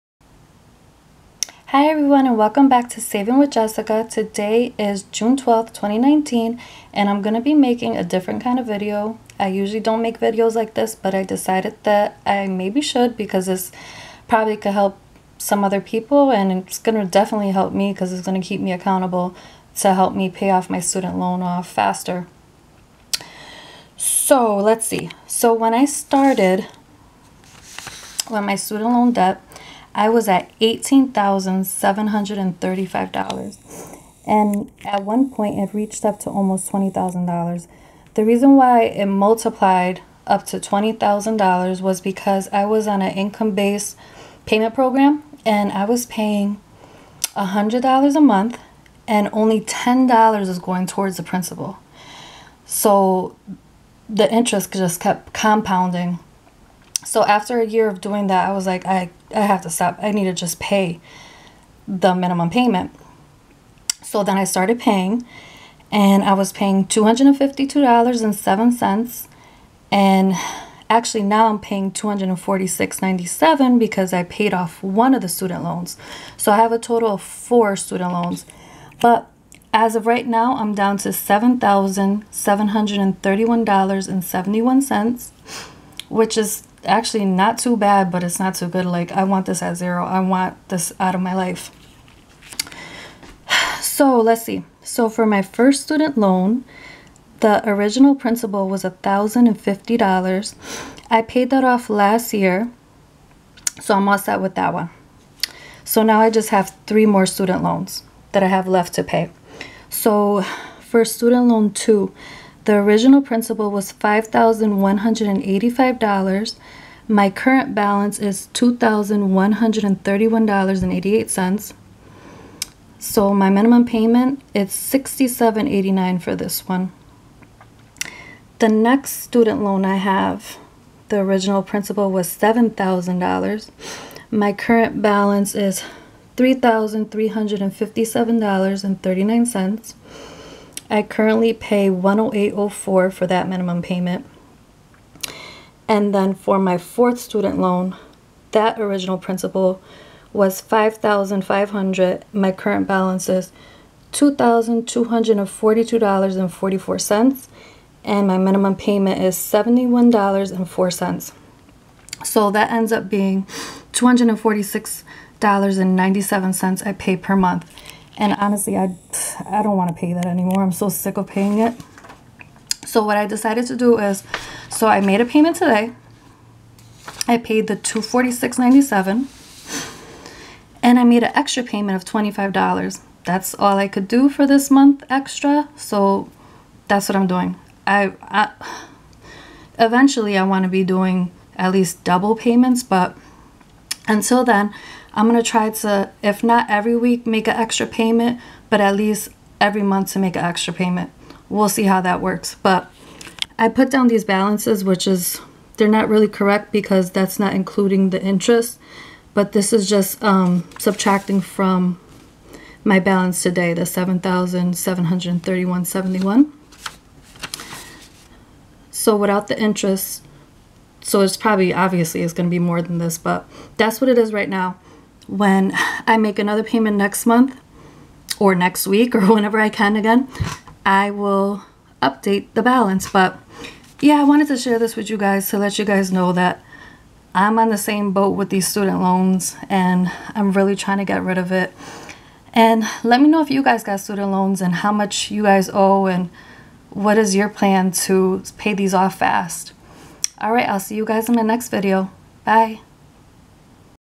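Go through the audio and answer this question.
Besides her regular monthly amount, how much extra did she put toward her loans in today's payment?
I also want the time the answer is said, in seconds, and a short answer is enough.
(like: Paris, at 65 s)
$25, at 182 s.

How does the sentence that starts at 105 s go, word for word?
So now I just have three more student loans that I have left to pay.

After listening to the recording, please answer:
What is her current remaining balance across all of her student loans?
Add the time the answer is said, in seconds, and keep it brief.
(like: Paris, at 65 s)
$7,731.71, at 81 s.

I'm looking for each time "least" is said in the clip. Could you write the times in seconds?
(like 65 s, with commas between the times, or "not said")
191 s, 198 s.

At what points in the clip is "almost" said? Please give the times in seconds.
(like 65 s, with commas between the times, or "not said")
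36 s.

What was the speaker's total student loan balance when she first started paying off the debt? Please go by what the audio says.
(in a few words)
$18,735.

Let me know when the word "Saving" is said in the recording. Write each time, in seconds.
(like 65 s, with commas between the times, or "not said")
2 s.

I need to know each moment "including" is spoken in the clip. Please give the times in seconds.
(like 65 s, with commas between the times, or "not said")
207 s.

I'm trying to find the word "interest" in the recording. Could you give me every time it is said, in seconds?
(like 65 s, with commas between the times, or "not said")
54 s, 208 s, 219 s.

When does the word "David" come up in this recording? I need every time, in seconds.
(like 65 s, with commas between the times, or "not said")
not said.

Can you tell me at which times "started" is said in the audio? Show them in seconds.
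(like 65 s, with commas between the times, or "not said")
25 s, 64 s.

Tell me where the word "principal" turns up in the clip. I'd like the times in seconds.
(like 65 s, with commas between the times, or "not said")
51 s, 98 s.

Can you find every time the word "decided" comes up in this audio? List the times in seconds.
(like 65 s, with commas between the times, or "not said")
11 s, 173 s.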